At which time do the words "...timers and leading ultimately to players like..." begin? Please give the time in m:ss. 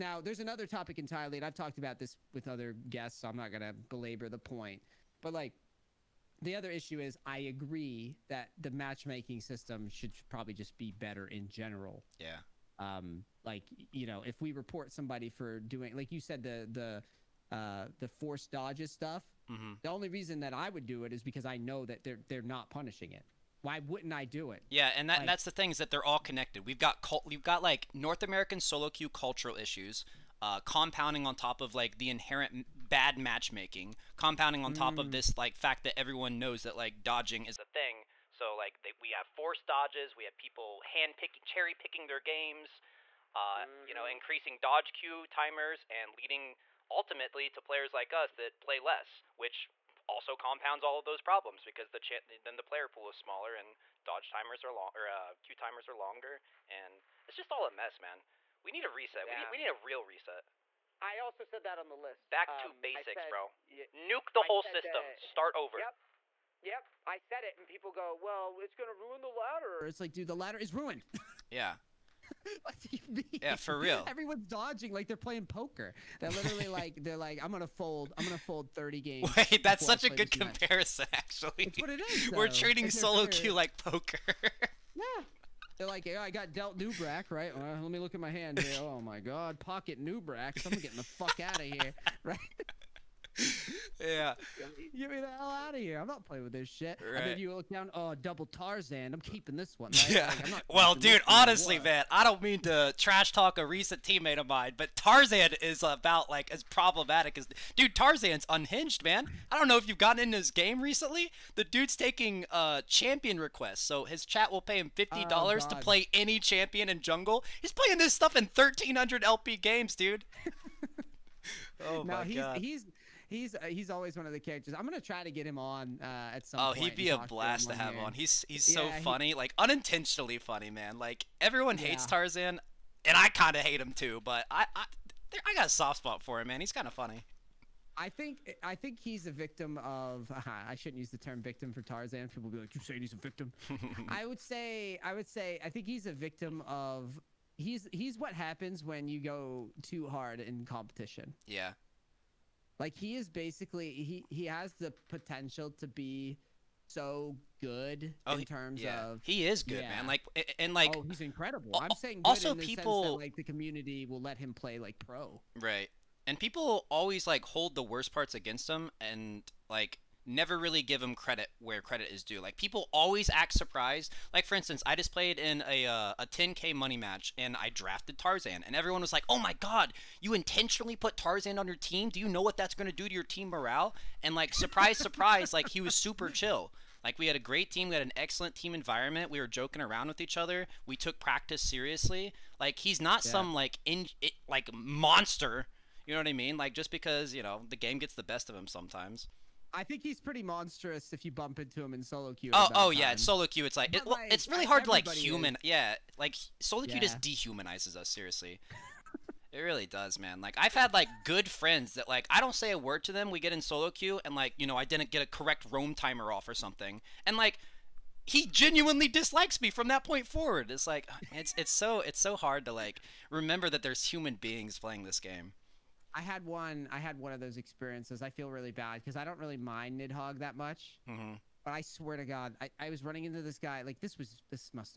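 0:45.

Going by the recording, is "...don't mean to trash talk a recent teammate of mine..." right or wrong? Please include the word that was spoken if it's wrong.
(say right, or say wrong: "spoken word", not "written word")
right.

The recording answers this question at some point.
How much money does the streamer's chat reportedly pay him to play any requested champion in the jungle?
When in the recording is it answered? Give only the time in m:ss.
1:54.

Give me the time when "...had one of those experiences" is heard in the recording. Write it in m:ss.
3:46.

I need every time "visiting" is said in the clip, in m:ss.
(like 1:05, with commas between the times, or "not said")
not said.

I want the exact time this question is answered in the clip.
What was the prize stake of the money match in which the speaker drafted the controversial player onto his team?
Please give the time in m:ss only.
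2:56.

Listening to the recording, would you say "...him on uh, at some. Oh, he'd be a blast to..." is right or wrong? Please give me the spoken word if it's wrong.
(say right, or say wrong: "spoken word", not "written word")
right.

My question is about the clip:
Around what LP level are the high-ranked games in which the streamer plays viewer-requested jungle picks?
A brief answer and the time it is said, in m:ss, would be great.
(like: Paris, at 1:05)
1,300 LP, at 1:58.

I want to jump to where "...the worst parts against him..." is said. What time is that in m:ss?
2:47.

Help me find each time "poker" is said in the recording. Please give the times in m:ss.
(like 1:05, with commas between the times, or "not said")
1:15, 1:23.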